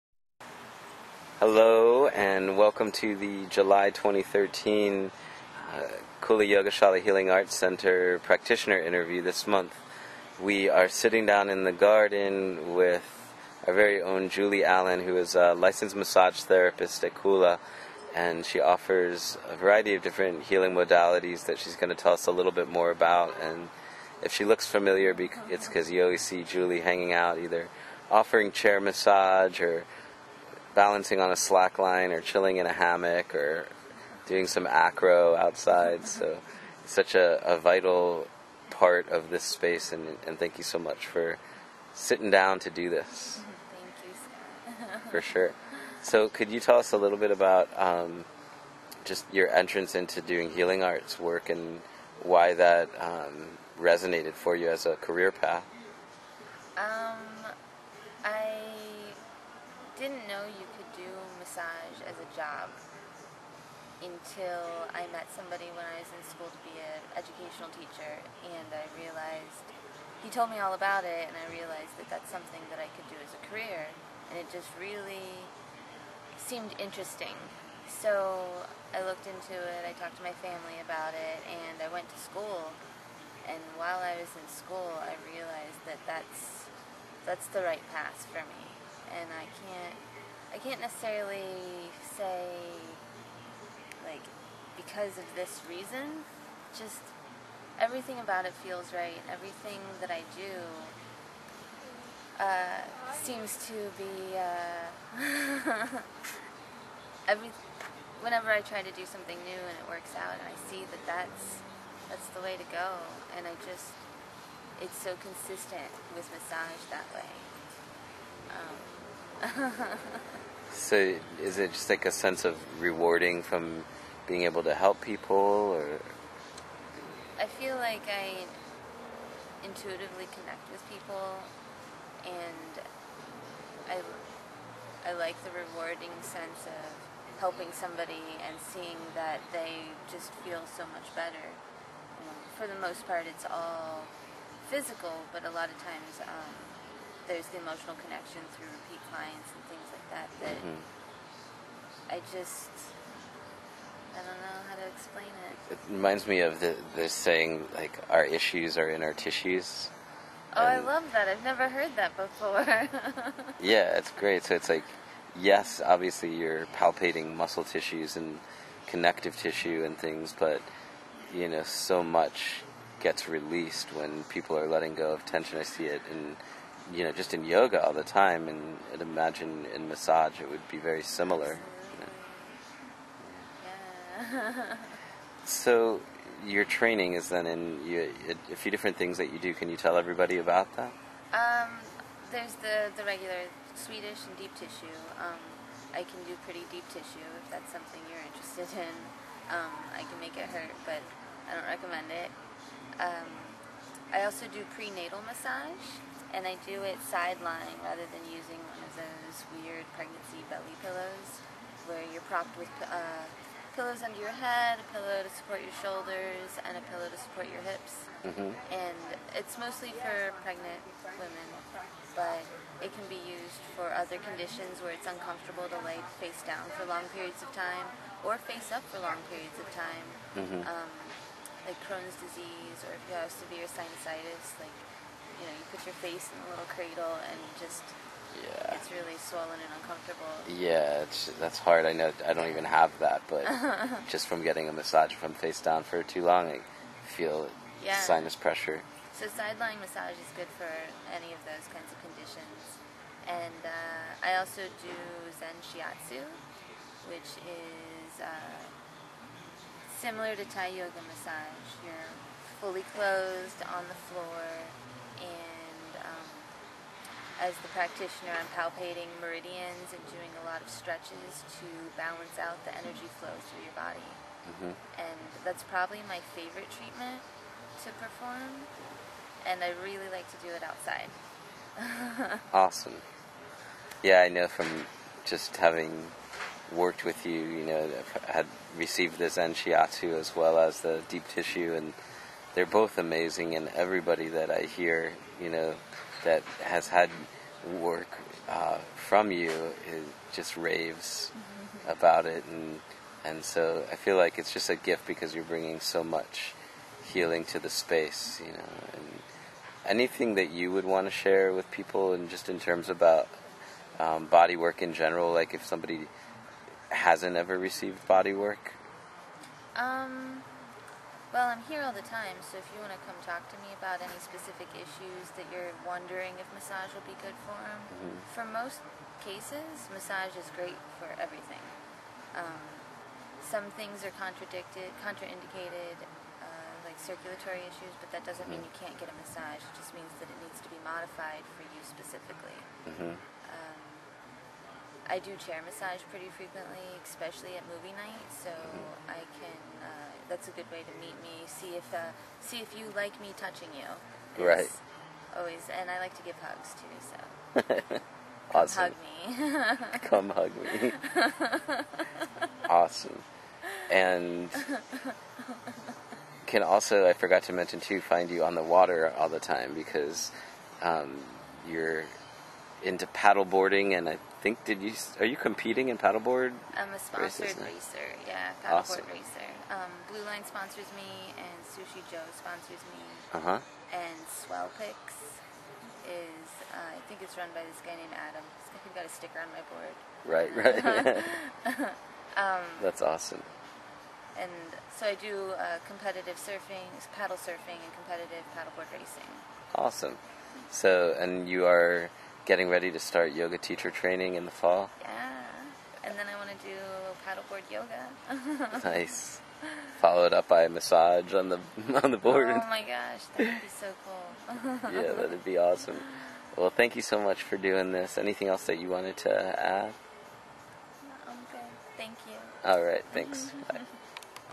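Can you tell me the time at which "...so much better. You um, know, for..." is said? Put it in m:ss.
2:20.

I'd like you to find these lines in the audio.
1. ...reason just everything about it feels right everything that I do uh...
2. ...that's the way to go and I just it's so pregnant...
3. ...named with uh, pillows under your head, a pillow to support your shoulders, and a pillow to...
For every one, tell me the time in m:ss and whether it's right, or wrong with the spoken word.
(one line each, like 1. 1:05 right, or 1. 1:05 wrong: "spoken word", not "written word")
1. 1:35 right
2. 1:52 wrong: "consistent", not "pregnant"
3. 3:32 wrong: "propped", not "named".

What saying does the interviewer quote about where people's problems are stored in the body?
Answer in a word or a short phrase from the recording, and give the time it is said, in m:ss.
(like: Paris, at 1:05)
our issues are in our tissues, at 2:38.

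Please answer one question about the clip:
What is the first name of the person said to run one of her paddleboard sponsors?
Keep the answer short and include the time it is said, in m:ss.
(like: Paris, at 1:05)
Adam, at 6:28.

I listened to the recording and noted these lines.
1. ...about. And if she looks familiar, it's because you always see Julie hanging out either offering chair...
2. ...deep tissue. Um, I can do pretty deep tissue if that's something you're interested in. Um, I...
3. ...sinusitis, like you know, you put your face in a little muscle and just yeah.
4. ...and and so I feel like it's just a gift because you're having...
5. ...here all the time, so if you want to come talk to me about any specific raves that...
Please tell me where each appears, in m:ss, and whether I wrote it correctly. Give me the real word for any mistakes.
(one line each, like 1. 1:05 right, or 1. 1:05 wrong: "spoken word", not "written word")
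1. 0:22 right
2. 3:14 right
3. 3:53 wrong: "cradle", not "muscle"
4. 5:02 wrong: "bringing", not "having"
5. 5:21 wrong: "issues", not "raves".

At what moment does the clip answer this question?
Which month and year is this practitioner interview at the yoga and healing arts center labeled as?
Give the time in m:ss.
0:03.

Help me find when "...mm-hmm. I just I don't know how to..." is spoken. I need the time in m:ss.
2:30.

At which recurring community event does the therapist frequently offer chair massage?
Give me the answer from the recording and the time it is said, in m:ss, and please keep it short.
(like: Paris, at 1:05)
movie night, at 5:47.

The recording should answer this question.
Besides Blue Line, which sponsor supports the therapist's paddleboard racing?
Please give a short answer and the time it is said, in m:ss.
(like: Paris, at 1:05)
Sushi Joe, at 6:21.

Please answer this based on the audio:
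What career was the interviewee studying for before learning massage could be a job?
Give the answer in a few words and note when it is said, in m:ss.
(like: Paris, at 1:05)
educational teacher, at 1:07.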